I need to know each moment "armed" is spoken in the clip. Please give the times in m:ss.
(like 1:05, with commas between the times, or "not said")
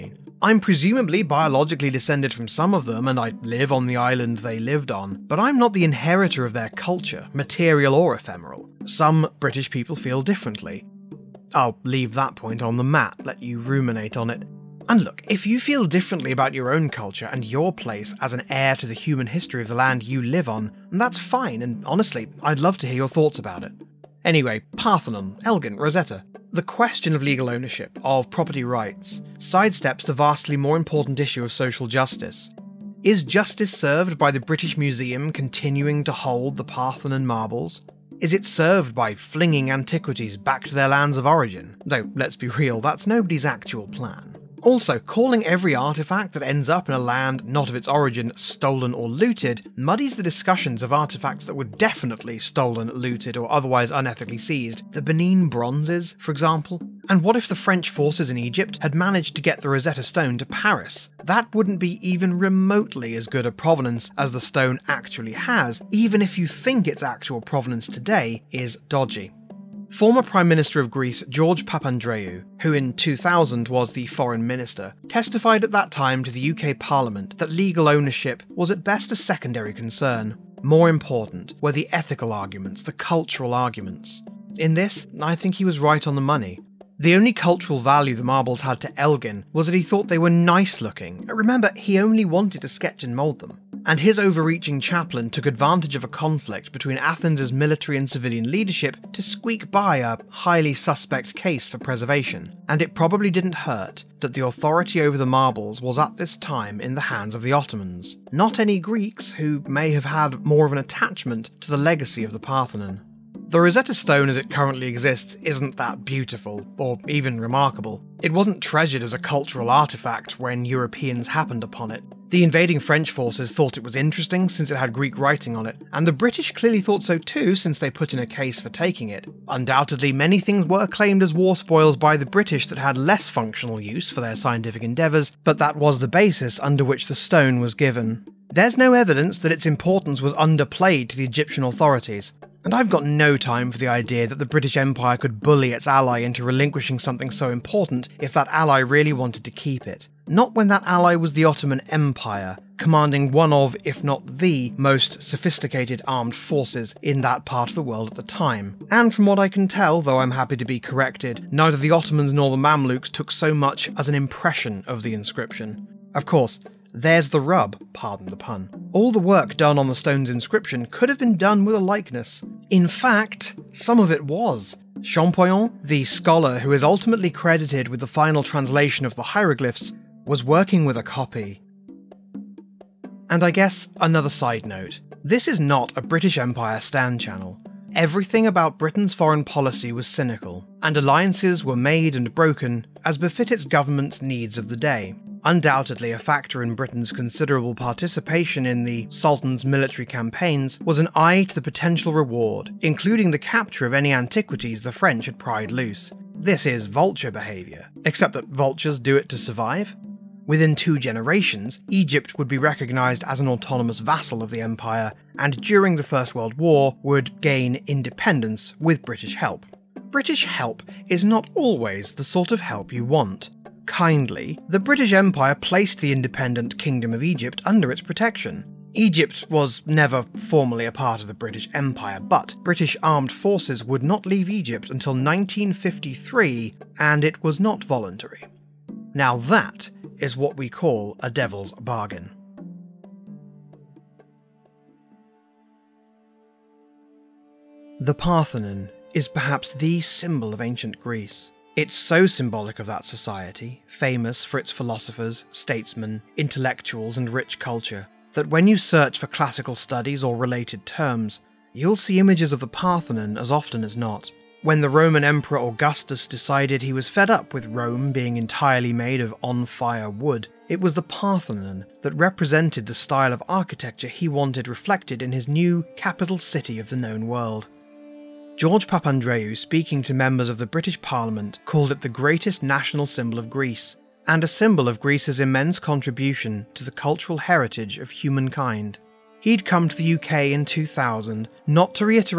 2:36, 3:53.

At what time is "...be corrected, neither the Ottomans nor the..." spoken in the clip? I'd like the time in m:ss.
2:40.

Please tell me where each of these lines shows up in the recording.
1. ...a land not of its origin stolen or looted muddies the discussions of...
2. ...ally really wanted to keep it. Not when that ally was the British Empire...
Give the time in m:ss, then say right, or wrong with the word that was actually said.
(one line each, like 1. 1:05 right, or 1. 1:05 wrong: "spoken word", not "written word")
1. 0:46 right
2. 2:28 wrong: "Ottoman", not "British".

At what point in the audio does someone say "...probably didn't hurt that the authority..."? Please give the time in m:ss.
1:42.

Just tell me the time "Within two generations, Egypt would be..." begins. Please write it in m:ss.
3:30.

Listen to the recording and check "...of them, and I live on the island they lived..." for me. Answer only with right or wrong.
right.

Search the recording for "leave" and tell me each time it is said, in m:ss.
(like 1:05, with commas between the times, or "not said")
0:11, 3:54.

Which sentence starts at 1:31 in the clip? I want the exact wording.
Remember, he only wanted to sketch and mould them.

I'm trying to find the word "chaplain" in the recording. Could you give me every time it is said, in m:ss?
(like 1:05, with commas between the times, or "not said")
1:34.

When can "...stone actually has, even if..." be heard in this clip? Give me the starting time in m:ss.
1:04.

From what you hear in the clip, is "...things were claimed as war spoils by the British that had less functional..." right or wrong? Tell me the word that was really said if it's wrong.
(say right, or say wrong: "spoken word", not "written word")
right.